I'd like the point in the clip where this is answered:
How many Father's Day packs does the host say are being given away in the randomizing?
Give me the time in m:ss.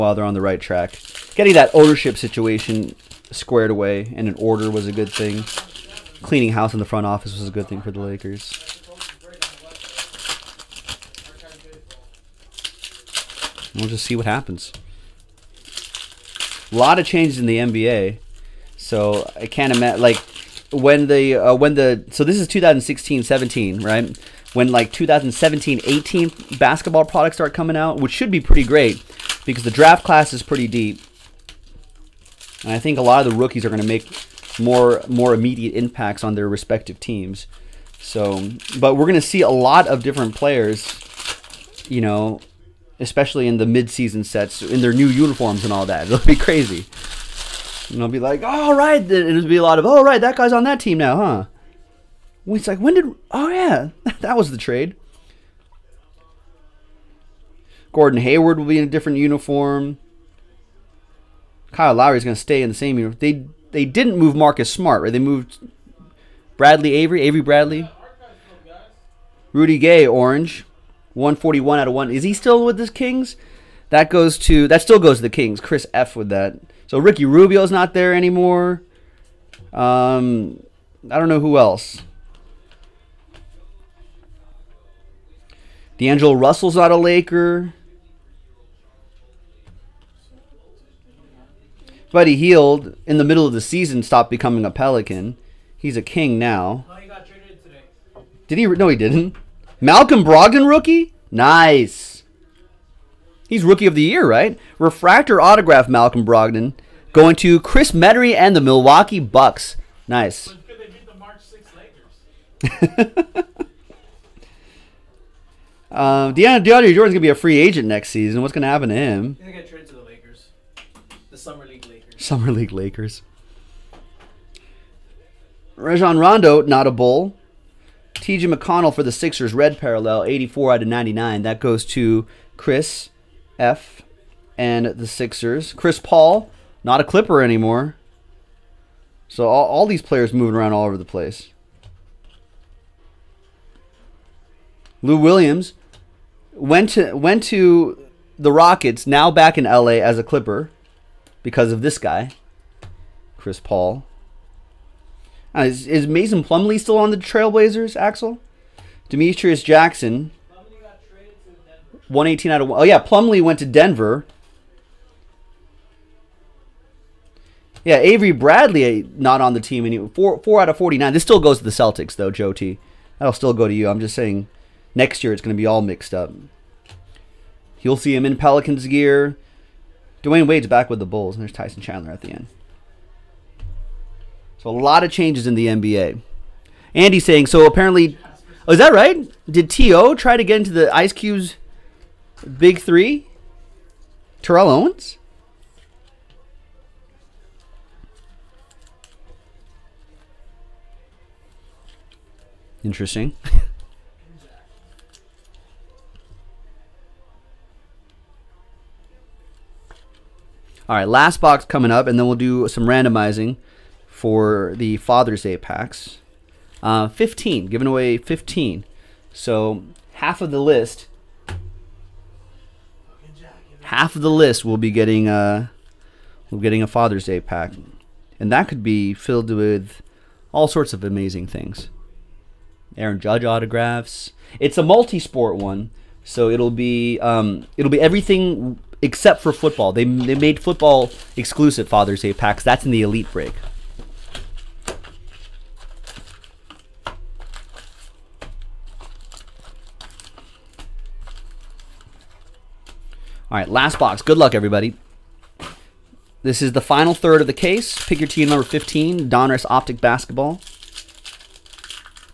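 3:37.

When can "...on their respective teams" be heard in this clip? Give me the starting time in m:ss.
0:36.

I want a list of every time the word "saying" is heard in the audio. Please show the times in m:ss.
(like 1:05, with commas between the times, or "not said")
2:54, 3:07.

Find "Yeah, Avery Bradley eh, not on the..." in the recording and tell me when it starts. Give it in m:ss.
2:47.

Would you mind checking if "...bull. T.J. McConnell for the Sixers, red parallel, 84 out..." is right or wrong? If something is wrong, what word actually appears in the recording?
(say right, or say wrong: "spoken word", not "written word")
right.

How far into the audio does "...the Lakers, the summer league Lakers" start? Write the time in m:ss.
1:59.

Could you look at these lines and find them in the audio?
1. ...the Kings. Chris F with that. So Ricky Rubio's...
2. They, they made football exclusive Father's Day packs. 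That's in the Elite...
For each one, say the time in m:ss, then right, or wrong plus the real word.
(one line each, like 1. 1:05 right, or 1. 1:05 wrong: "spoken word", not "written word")
1. 1:15 right
2. 3:59 right.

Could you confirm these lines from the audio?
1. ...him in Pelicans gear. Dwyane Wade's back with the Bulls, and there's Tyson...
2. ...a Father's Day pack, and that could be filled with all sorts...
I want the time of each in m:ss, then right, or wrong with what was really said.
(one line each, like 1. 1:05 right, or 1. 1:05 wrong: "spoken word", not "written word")
1. 2:58 right
2. 3:46 right.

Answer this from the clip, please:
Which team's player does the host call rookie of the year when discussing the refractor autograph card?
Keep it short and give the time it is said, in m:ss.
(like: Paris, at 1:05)
Milwaukee Bucks, at 1:48.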